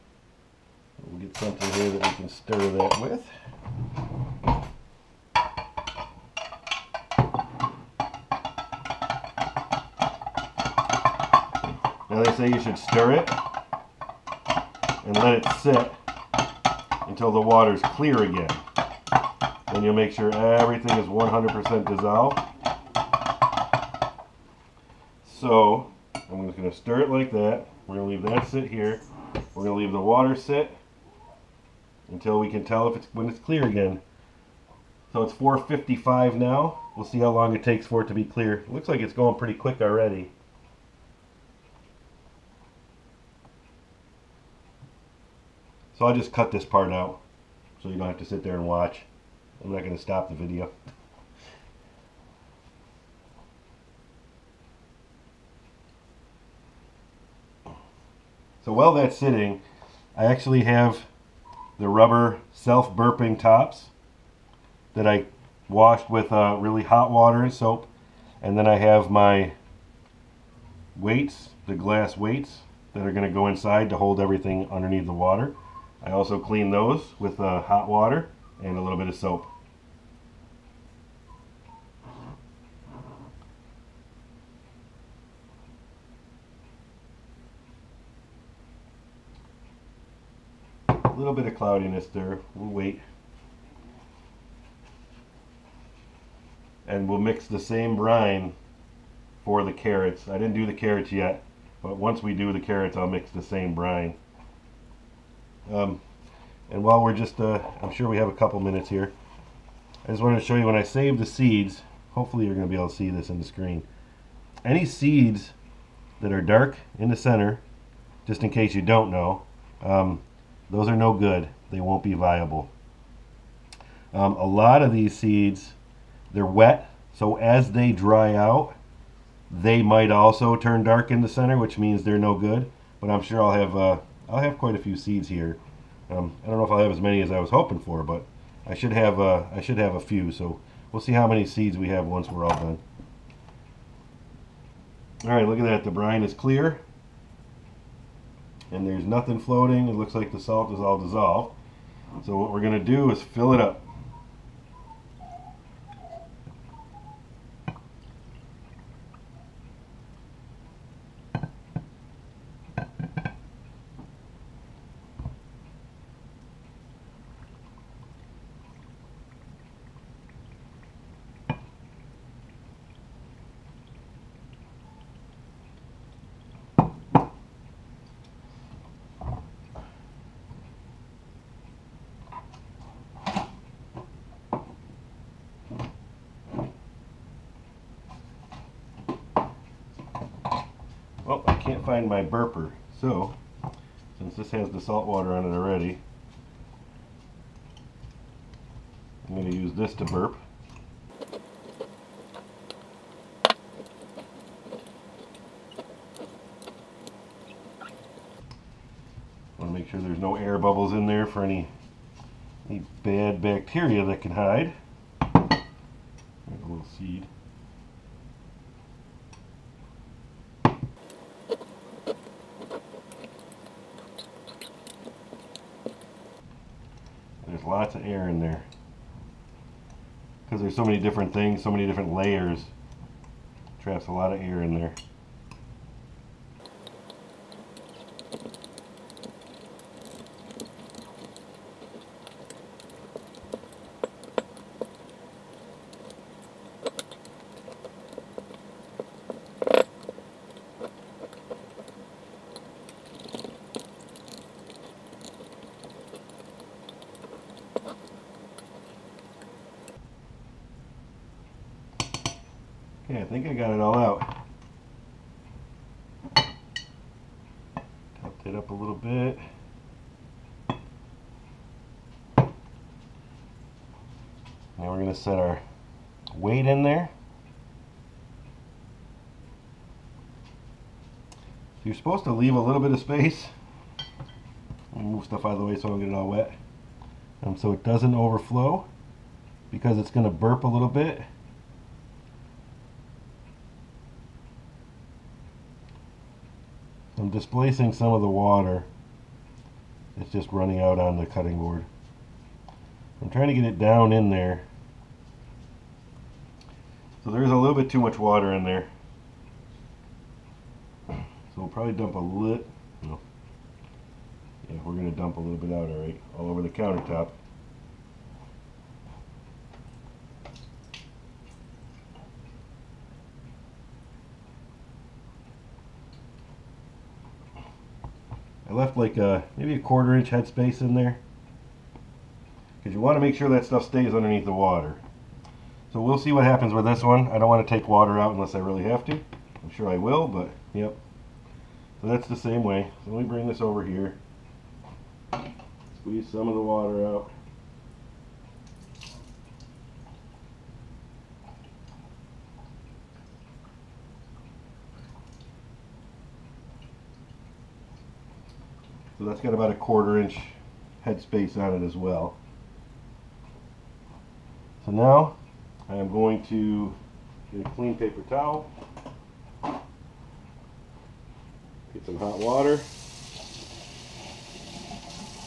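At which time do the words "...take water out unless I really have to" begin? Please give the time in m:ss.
5:37.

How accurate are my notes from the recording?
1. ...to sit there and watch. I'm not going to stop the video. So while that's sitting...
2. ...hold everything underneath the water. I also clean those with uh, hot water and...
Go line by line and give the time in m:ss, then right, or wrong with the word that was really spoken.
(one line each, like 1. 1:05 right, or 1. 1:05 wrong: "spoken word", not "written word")
1. 0:48 right
2. 1:13 right.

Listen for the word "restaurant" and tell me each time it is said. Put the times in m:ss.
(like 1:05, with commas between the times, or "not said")
not said.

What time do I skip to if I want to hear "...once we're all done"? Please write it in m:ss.
2:22.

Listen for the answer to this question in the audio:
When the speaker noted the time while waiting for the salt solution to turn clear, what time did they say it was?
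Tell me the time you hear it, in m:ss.
0:35.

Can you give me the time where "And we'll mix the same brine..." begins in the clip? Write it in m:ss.
1:36.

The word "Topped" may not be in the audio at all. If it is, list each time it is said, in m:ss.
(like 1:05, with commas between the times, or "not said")
4:28.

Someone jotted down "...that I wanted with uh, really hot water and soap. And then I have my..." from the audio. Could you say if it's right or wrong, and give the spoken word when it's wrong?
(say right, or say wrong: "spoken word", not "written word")
wrong: "washed", not "wanted".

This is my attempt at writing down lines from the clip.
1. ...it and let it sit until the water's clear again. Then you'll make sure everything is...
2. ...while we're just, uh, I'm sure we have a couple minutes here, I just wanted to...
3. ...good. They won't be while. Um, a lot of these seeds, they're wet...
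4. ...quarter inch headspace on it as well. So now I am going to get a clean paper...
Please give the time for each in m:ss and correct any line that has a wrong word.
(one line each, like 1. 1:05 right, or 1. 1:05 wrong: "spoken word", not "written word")
1. 0:13 right
2. 1:46 right
3. 2:01 wrong: "viable", not "while"
4. 5:59 right.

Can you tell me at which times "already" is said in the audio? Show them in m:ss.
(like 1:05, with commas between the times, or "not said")
0:39, 3:15.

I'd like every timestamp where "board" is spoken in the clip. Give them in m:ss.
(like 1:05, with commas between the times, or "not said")
5:01.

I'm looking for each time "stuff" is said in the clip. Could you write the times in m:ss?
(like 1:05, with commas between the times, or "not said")
4:45, 5:33.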